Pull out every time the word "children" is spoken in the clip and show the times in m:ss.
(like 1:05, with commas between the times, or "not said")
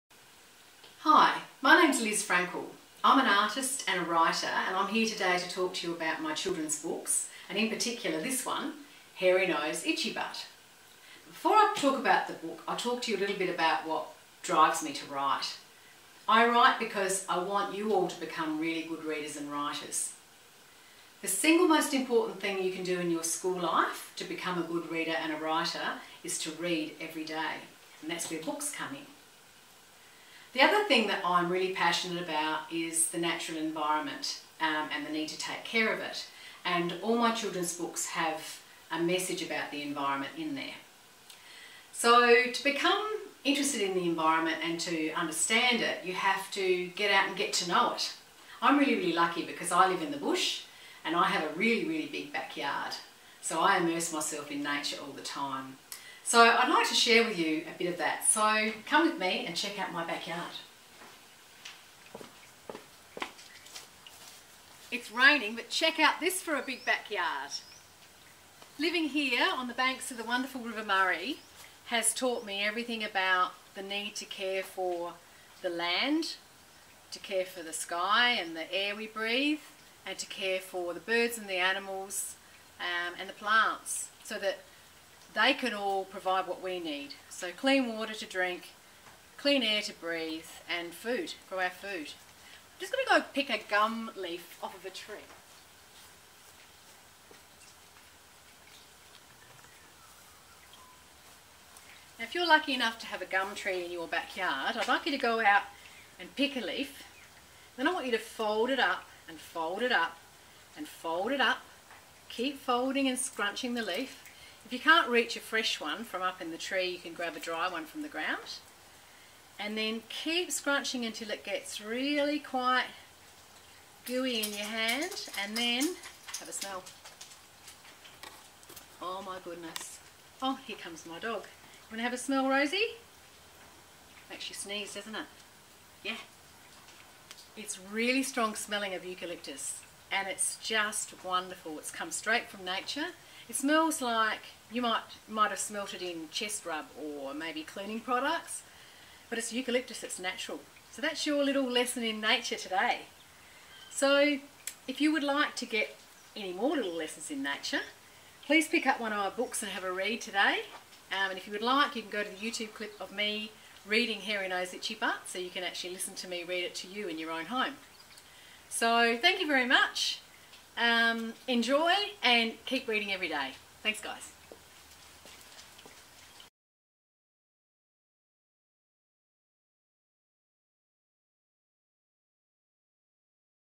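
0:06, 0:37.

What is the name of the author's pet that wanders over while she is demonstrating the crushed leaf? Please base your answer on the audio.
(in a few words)
Rosie.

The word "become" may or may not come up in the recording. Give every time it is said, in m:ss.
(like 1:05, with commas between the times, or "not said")
0:18, 0:24, 0:42.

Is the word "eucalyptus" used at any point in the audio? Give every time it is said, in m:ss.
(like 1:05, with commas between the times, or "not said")
2:19, 2:29.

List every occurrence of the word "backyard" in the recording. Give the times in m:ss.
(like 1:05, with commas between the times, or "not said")
0:52, 1:00, 1:06, 1:44.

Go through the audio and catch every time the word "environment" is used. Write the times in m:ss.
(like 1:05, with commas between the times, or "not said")
0:33, 0:39, 0:44.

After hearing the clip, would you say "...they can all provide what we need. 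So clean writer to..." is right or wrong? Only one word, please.
wrong.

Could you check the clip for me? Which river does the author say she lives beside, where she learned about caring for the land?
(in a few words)
River Murray.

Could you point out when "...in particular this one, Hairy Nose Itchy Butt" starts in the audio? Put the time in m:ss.
0:07.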